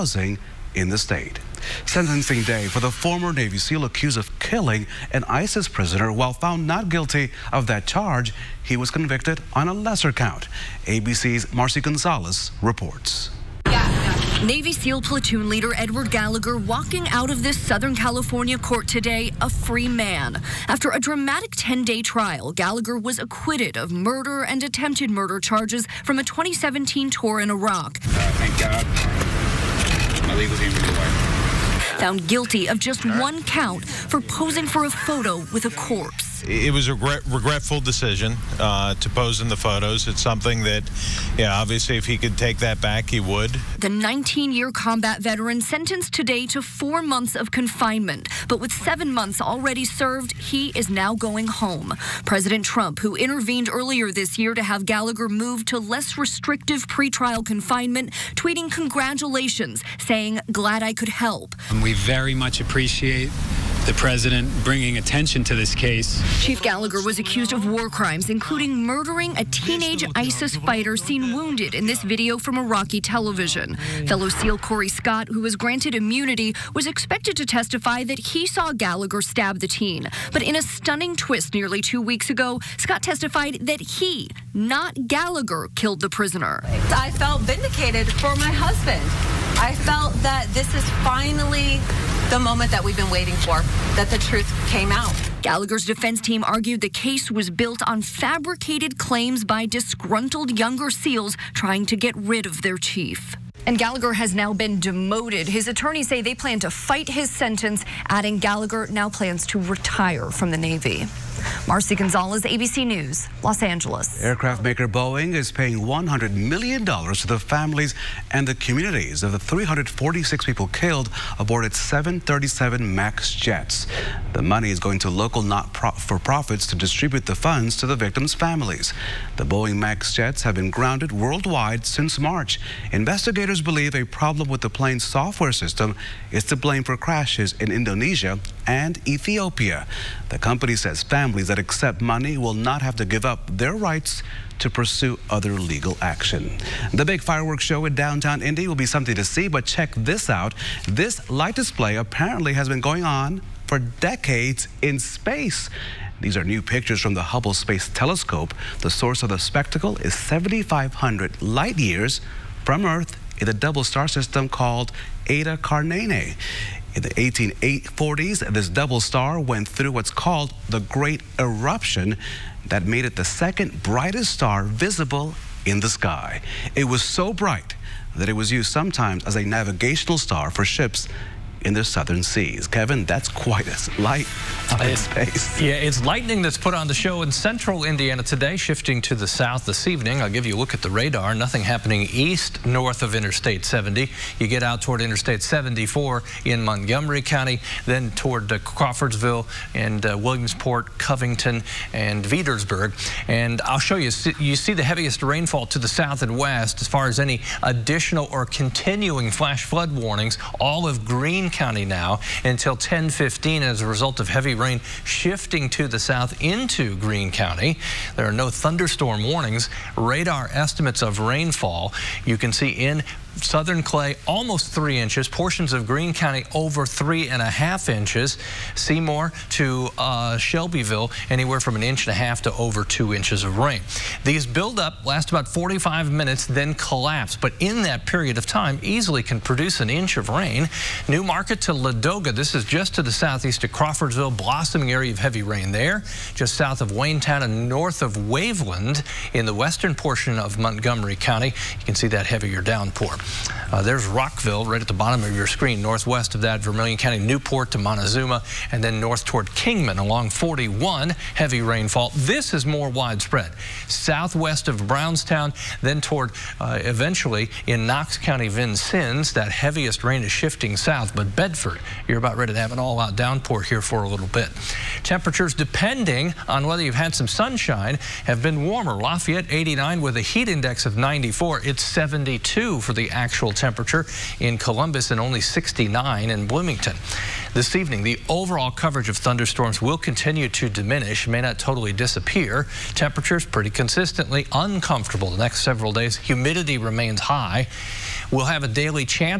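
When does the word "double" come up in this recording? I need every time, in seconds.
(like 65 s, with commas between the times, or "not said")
163 s, 168 s.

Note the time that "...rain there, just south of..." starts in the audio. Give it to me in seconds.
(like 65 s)
245 s.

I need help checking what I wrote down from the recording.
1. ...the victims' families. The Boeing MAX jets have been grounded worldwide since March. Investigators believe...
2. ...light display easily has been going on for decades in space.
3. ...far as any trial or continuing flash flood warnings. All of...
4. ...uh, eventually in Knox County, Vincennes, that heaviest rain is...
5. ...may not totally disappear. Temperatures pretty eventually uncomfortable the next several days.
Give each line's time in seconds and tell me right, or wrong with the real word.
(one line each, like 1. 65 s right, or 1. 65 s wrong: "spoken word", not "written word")
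1. 127 s right
2. 151 s wrong: "apparently", not "easily"
3. 206 s wrong: "additional", not "trial"
4. 266 s right
5. 291 s wrong: "consistently", not "eventually".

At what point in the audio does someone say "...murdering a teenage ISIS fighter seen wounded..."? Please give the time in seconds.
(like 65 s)
68 s.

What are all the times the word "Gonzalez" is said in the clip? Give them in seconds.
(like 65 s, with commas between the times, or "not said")
11 s, 111 s.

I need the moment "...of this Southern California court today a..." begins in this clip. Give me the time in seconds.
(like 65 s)
17 s.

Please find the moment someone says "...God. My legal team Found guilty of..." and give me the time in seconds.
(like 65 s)
28 s.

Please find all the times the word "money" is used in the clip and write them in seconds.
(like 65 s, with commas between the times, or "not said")
124 s, 142 s.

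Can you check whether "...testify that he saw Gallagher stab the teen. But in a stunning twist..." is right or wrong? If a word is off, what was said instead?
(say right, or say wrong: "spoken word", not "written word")
right.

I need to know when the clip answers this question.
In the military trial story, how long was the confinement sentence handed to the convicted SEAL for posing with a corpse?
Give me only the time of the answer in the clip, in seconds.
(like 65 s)
46 s.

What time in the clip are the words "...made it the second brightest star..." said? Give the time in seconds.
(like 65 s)
172 s.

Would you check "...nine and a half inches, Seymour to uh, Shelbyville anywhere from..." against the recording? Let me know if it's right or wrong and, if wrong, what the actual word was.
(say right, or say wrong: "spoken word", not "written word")
wrong: "three", not "nine".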